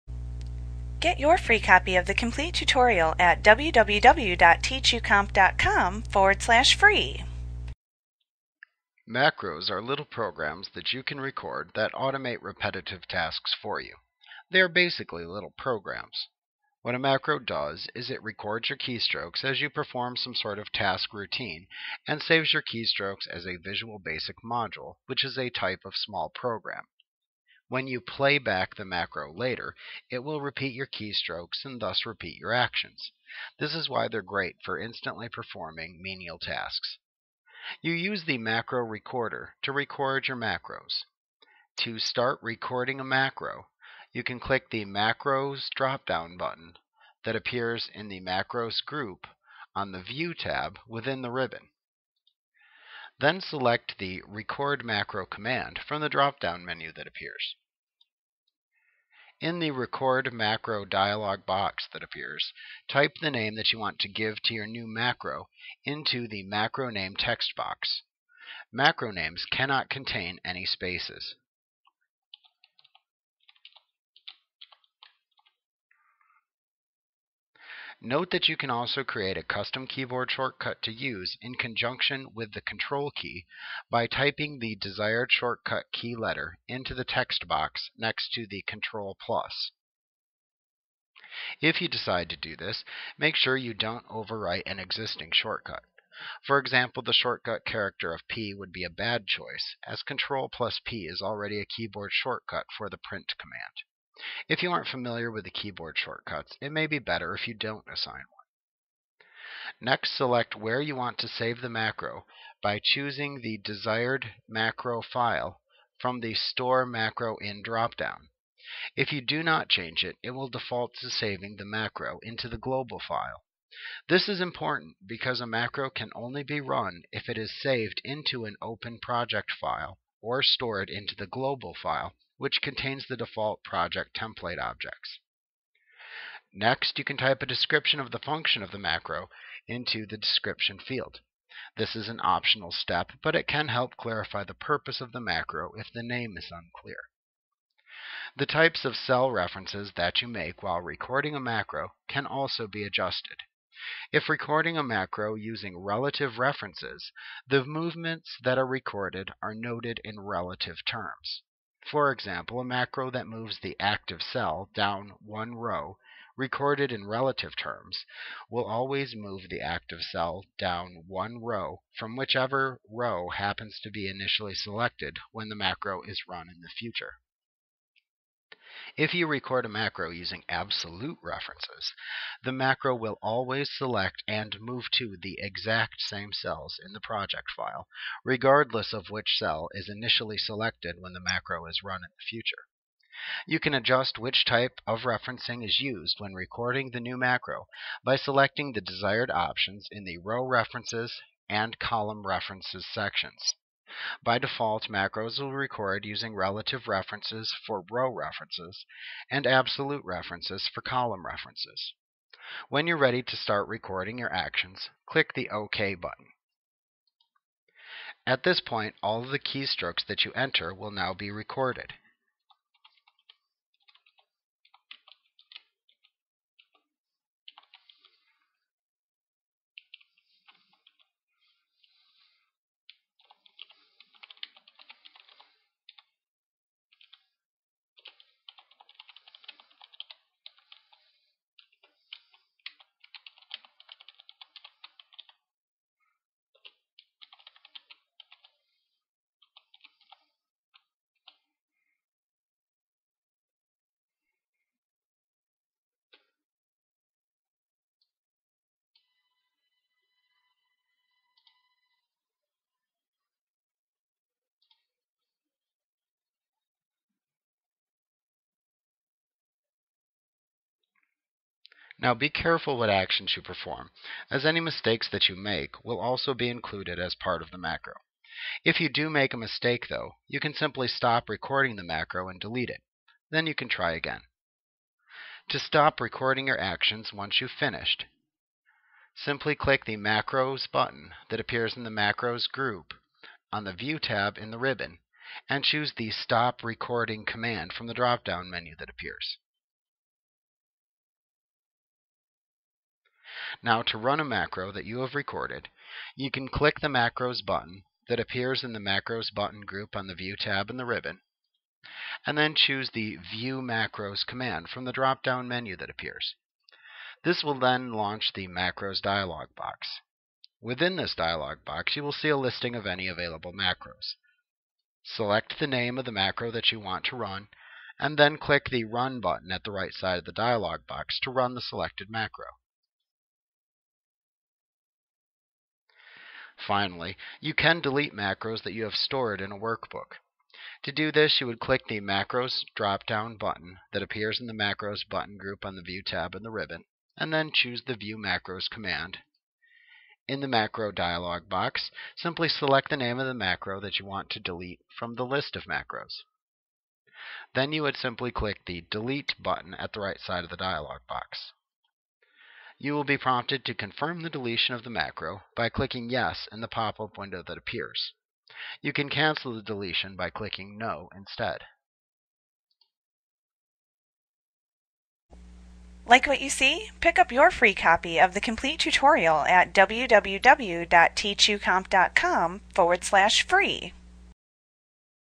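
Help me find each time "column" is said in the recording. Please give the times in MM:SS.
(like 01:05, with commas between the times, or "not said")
03:21, 03:30.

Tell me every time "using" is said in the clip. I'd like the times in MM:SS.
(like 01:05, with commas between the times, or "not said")
02:35, 03:00, 03:26.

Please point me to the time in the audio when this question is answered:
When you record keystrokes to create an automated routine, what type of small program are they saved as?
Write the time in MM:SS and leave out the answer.
00:23.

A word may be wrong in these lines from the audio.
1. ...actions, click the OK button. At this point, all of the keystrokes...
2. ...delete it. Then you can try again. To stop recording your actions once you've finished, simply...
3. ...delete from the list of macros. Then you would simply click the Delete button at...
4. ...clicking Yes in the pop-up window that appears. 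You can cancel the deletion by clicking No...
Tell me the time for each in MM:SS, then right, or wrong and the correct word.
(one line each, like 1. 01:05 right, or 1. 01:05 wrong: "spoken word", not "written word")
1. 03:34 right
2. 04:42 right
3. 05:54 right
4. 06:05 right.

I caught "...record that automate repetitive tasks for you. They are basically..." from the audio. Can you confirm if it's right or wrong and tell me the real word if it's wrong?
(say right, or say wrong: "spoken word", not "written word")
right.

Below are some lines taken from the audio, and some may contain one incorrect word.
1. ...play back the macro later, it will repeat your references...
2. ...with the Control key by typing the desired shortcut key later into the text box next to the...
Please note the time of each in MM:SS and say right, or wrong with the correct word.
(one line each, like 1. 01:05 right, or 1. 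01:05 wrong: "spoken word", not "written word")
1. 00:28 wrong: "keystrokes", not "references"
2. 01:22 wrong: "letter", not "later".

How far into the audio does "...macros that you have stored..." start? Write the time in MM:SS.
05:38.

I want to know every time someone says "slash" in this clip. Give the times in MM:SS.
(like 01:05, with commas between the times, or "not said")
00:06, 06:23.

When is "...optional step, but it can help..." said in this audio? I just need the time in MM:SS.
02:22.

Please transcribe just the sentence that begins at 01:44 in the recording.
If you aren't familiar with the keyboard shortcuts, it may be better if you don't assign one.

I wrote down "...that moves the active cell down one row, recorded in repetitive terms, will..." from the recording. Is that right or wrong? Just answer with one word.
wrong.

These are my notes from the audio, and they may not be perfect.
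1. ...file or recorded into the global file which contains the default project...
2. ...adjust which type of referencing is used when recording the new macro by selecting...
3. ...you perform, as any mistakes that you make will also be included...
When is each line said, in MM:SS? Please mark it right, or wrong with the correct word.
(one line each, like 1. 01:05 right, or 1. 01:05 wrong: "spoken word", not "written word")
1. 02:09 wrong: "stored", not "recorded"
2. 03:13 right
3. 04:33 right.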